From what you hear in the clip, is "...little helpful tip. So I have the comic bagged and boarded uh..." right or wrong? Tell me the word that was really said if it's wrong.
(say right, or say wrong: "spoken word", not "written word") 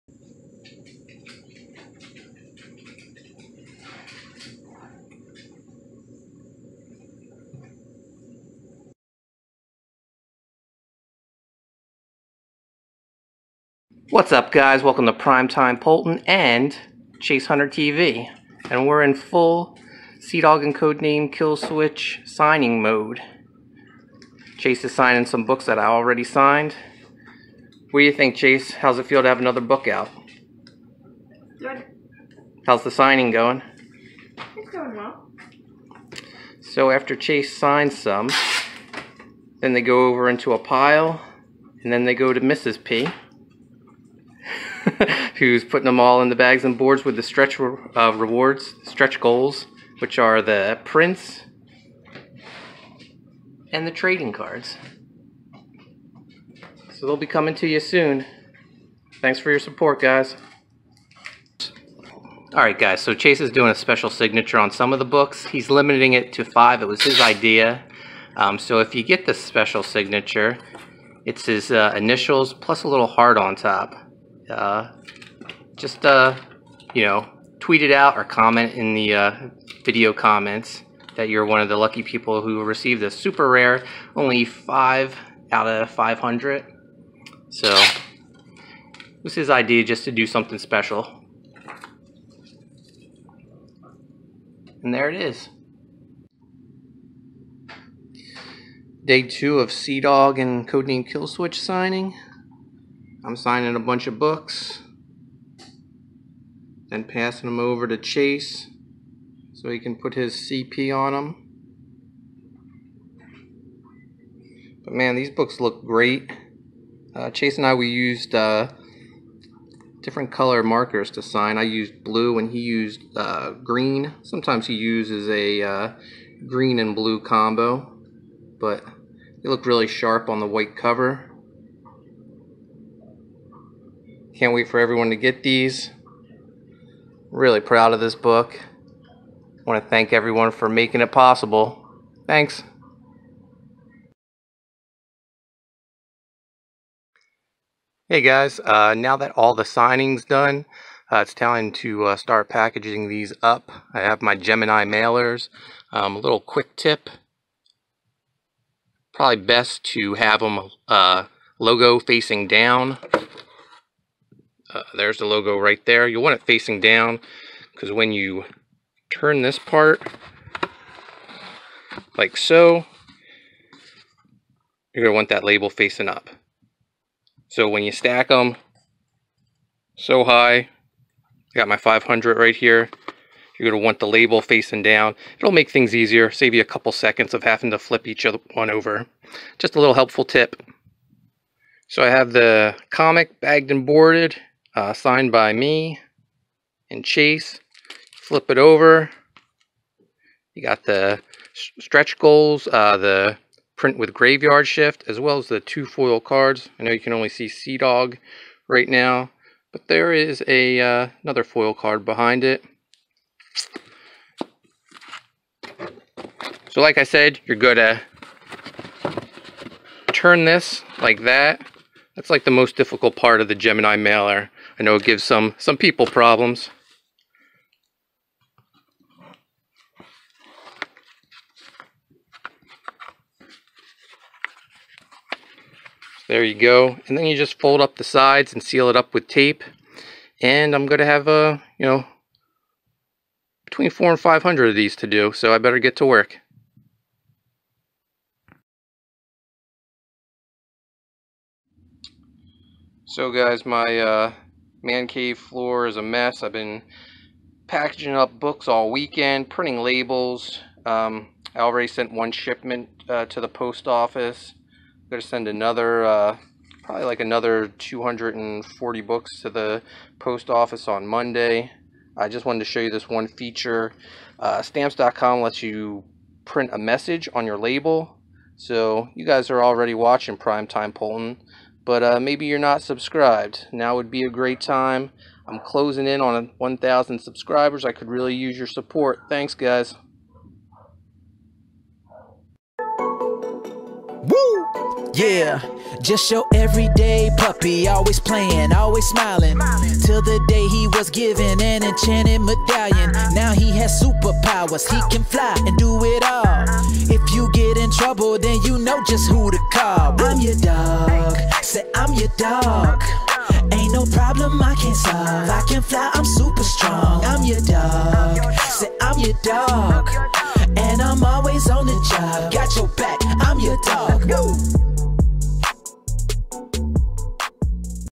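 right.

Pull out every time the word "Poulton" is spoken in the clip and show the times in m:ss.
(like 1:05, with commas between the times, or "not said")
0:15, 4:40.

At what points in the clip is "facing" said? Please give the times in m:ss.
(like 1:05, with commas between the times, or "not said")
2:41, 2:46, 2:55, 3:04.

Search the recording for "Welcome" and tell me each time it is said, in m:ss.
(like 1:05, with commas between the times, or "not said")
0:14.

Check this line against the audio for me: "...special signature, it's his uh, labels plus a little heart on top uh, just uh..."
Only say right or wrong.
wrong.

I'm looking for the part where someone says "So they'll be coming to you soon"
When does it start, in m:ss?
0:56.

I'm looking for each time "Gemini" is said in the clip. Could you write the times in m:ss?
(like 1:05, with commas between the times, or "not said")
2:34, 3:43.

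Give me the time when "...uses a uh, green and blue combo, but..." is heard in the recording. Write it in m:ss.
2:04.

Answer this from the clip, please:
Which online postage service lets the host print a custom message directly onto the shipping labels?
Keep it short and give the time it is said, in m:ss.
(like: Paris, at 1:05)
stamps.com, at 4:34.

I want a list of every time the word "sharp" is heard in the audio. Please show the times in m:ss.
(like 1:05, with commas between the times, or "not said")
2:09.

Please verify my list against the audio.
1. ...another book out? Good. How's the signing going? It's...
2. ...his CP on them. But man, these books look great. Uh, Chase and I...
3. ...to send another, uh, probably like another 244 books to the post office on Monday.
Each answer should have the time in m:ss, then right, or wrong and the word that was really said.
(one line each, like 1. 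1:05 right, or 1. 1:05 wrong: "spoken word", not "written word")
1. 0:29 right
2. 1:50 right
3. 4:25 wrong: "240", not "244".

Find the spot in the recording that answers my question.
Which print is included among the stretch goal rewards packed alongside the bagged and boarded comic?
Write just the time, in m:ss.
3:24.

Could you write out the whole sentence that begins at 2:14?
Can't wait for everyone to get these.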